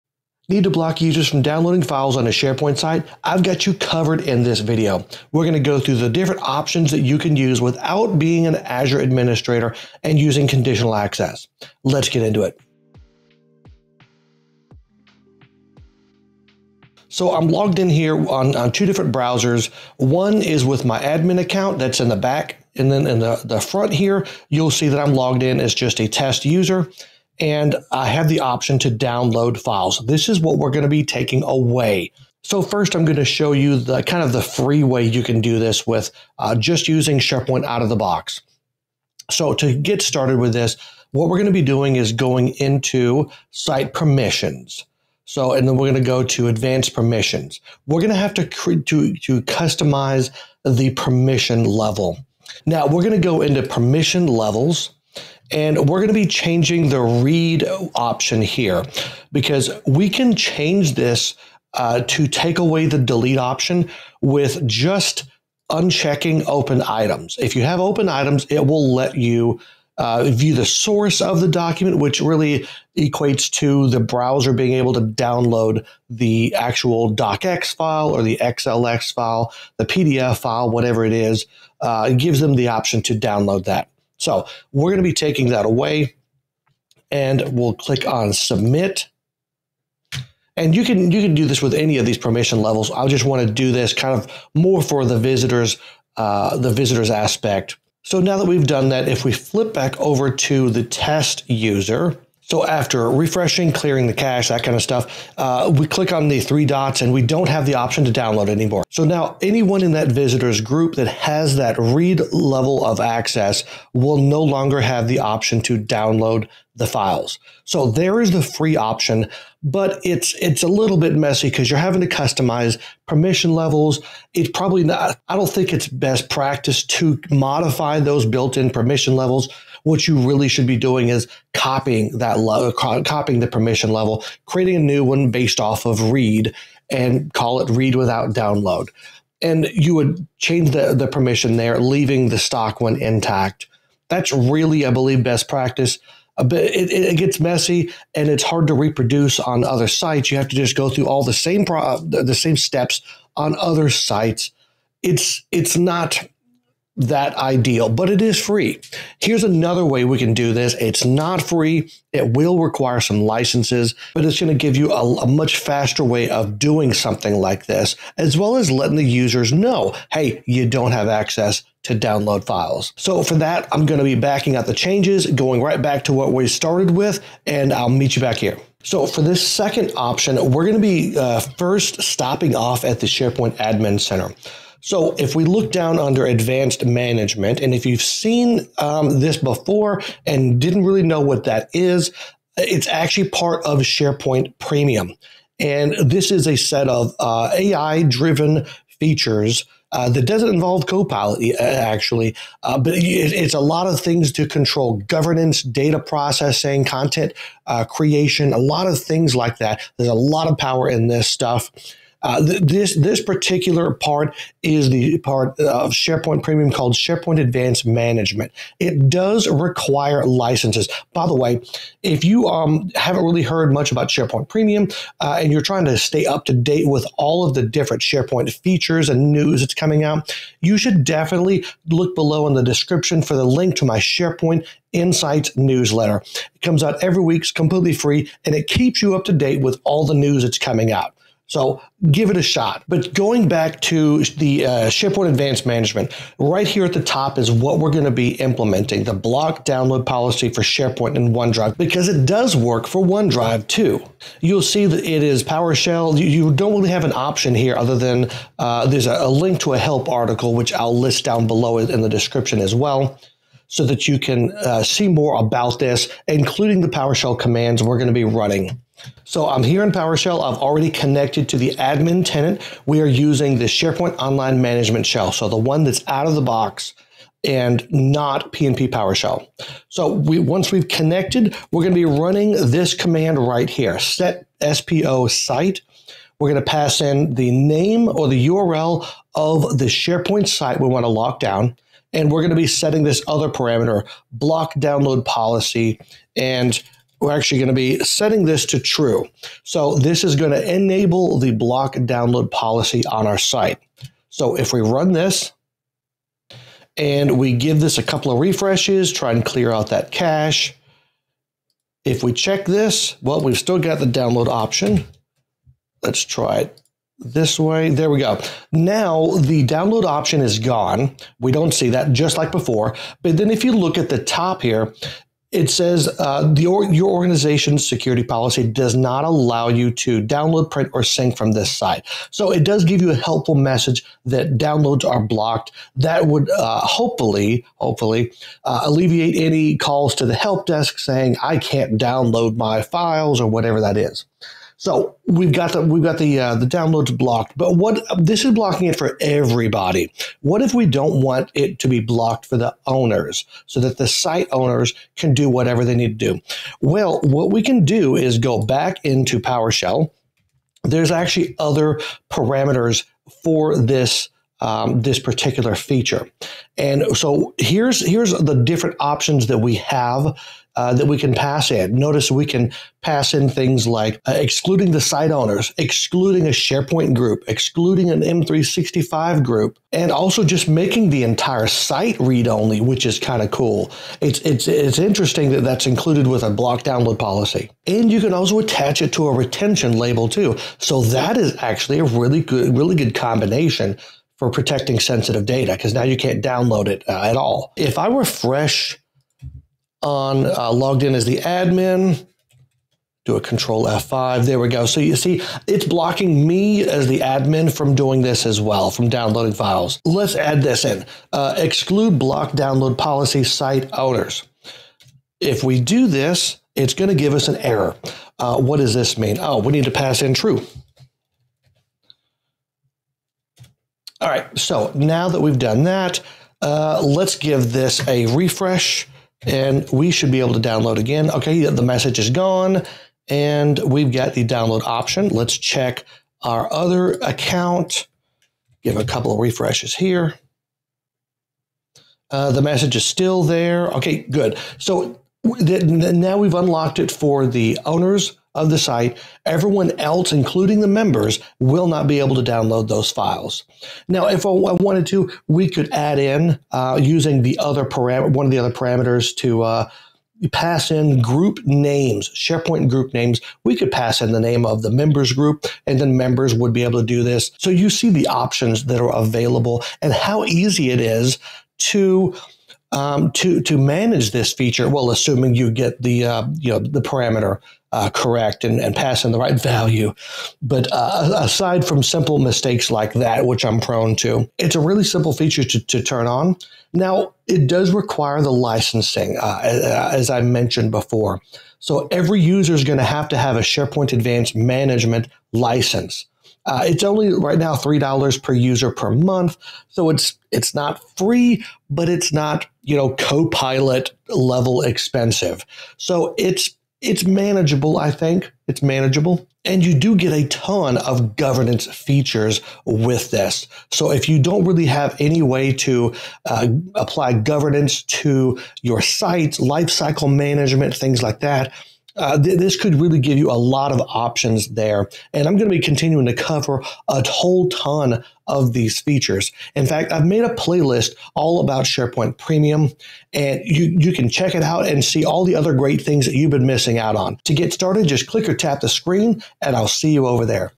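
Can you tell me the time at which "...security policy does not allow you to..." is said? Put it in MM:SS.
05:27.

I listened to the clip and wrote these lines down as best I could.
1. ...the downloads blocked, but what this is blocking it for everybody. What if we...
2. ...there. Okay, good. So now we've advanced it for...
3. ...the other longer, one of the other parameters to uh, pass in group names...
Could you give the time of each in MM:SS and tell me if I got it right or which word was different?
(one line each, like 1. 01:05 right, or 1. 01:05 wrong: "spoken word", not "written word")
1. 05:46 right
2. 07:23 wrong: "unlocked", not "advanced"
3. 07:37 wrong: "parameter", not "longer".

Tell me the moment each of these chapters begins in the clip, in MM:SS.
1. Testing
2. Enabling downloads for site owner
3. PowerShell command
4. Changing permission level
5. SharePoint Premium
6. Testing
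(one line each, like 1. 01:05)
1. 01:37
2. 06:49
3. 04:29
4. 00:40
5. 02:58
6. 05:07.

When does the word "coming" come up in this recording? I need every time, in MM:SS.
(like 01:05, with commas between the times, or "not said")
03:49, 04:00.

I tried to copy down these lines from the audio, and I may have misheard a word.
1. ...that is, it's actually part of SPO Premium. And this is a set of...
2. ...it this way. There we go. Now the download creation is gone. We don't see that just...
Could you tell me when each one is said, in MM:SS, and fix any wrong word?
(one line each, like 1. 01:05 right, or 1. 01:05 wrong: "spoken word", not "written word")
1. 03:11 wrong: "SharePoint", not "SPO"
2. 05:16 wrong: "option", not "creation".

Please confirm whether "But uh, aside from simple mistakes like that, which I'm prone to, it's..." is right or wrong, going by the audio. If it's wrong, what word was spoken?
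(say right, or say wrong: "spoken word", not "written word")
right.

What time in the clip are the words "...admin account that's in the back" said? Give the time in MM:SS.
00:20.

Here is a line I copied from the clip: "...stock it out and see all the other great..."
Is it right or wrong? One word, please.
wrong.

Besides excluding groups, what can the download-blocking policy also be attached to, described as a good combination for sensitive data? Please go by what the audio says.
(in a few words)
A retention label.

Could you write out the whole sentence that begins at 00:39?
So to get started with this, what we're going to be doing is going into site permissions.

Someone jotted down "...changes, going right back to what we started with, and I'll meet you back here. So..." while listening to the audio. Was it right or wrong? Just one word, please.
right.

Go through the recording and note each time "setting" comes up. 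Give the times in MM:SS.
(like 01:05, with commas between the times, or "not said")
04:52, 04:58.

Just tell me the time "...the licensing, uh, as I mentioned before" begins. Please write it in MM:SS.
08:08.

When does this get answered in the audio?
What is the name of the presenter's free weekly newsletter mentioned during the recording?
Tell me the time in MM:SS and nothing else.
03:53.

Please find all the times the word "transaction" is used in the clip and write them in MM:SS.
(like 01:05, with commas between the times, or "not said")
not said.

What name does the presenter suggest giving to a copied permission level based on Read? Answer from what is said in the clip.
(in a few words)
Read without download.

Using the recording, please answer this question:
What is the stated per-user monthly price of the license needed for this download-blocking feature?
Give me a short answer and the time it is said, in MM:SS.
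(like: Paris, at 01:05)
$3, at 08:17.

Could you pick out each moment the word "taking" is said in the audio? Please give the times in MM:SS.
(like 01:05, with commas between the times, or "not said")
00:31, 01:25.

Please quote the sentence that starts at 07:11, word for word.
Okay, the message is gone and we've got the download option.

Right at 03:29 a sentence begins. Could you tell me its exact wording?
There's a lot of power in this stuff.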